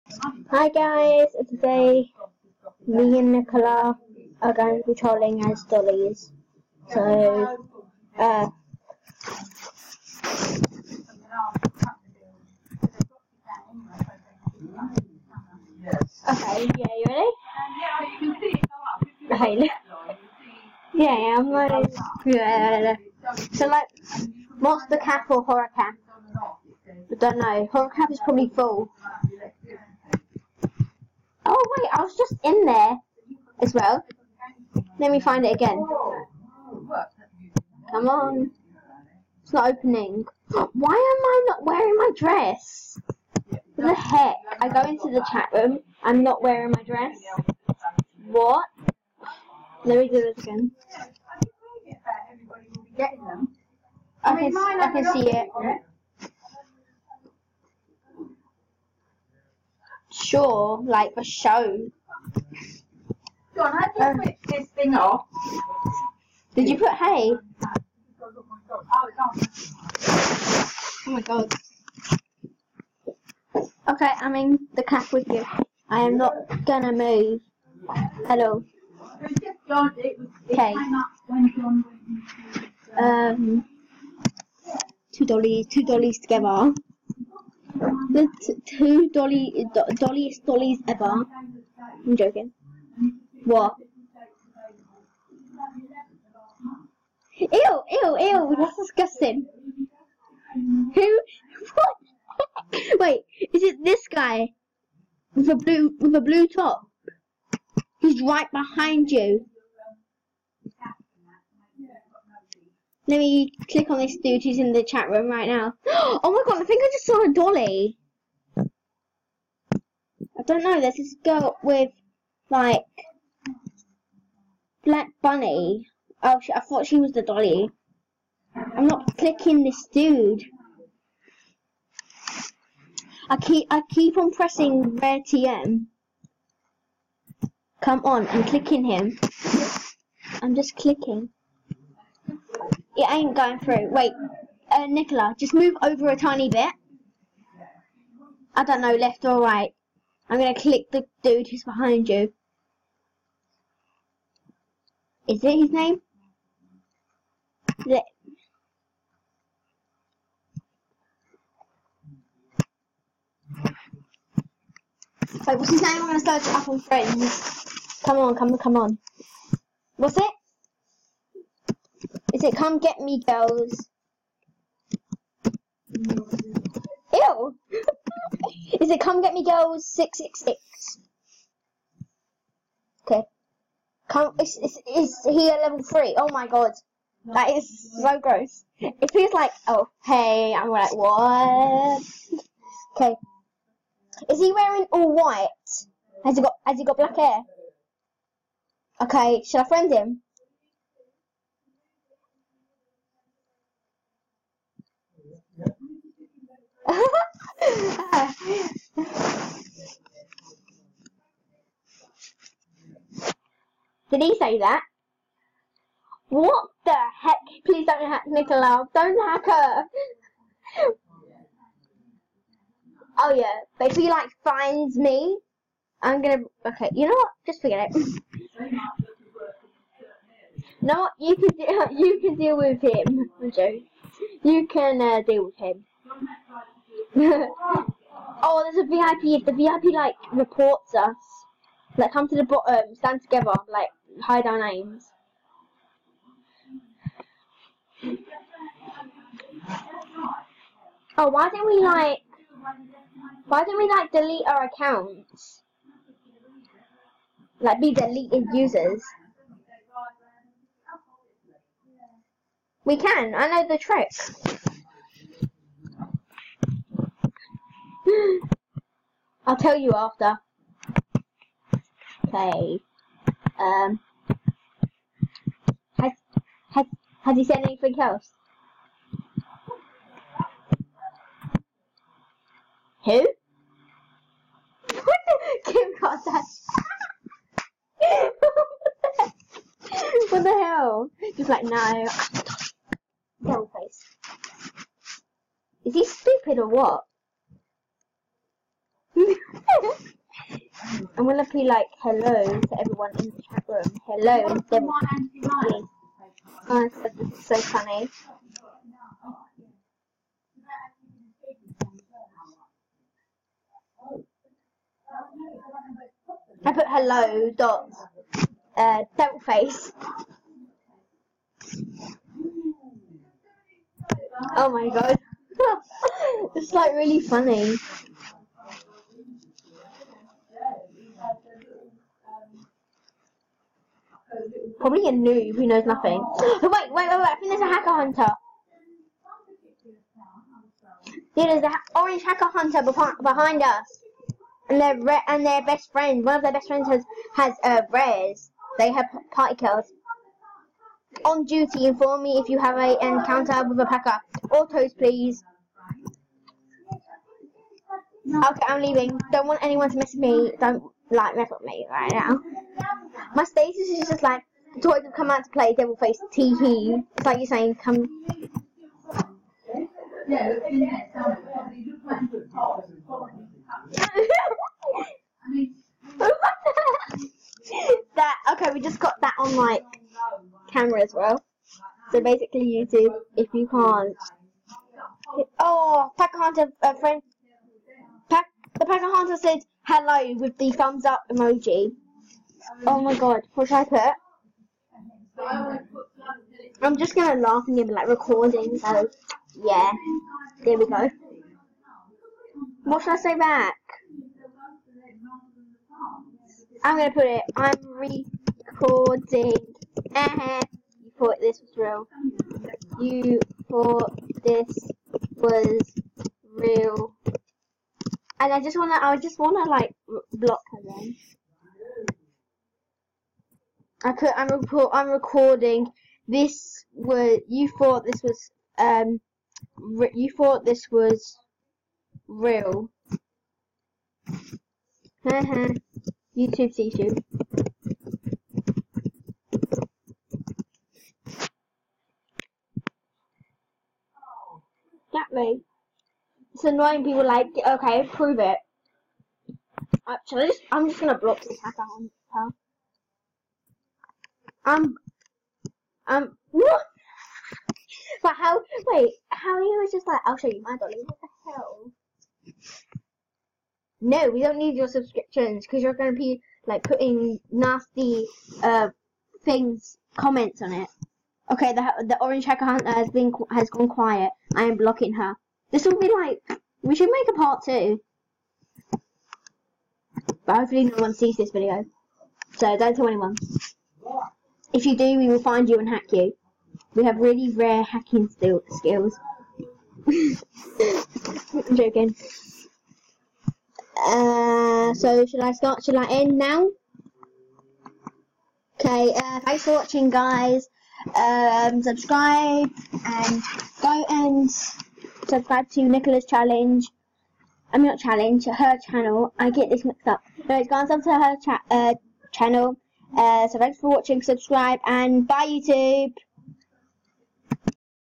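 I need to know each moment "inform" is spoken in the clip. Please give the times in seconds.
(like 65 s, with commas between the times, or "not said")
351 s.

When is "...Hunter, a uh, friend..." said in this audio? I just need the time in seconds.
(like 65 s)
386 s.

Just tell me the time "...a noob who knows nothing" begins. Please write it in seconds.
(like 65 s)
335 s.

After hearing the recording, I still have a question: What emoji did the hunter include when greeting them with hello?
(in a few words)
Thumbs up.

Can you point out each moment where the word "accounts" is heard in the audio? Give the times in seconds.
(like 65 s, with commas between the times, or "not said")
254 s, 451 s.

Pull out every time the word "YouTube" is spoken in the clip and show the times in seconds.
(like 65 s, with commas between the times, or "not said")
382 s, 436 s, 515 s.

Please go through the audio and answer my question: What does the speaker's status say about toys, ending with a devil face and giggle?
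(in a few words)
Toys have come out to play.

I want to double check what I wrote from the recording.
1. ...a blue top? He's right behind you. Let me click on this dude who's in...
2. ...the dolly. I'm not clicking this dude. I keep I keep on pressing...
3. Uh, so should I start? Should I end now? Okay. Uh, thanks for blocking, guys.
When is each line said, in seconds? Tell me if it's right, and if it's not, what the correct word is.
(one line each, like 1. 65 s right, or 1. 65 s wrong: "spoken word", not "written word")
1. 106 s right
2. 127 s right
3. 494 s wrong: "watching", not "blocking".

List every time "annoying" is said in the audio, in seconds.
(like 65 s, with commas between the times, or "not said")
446 s.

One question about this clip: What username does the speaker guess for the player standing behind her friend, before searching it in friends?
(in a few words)
Come Get Me Girls 666.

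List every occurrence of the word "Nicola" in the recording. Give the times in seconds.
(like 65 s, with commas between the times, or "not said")
3 s, 144 s, 218 s, 505 s.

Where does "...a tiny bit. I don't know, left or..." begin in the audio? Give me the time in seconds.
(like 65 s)
146 s.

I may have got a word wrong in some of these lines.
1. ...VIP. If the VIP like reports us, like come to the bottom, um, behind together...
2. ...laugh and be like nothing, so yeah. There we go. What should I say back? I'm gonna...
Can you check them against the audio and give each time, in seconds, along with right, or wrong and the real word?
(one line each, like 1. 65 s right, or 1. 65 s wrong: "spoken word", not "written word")
1. 238 s wrong: "stand", not "behind"
2. 397 s wrong: "recording", not "nothing".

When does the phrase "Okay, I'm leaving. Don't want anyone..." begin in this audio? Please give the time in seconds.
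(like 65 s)
358 s.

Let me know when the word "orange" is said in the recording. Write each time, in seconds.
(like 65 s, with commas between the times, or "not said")
341 s, 472 s.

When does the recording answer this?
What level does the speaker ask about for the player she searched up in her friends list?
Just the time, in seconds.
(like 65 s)
185 s.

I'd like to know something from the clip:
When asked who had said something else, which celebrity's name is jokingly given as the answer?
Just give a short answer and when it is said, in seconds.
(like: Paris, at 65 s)
Kim Kardashian, at 285 s.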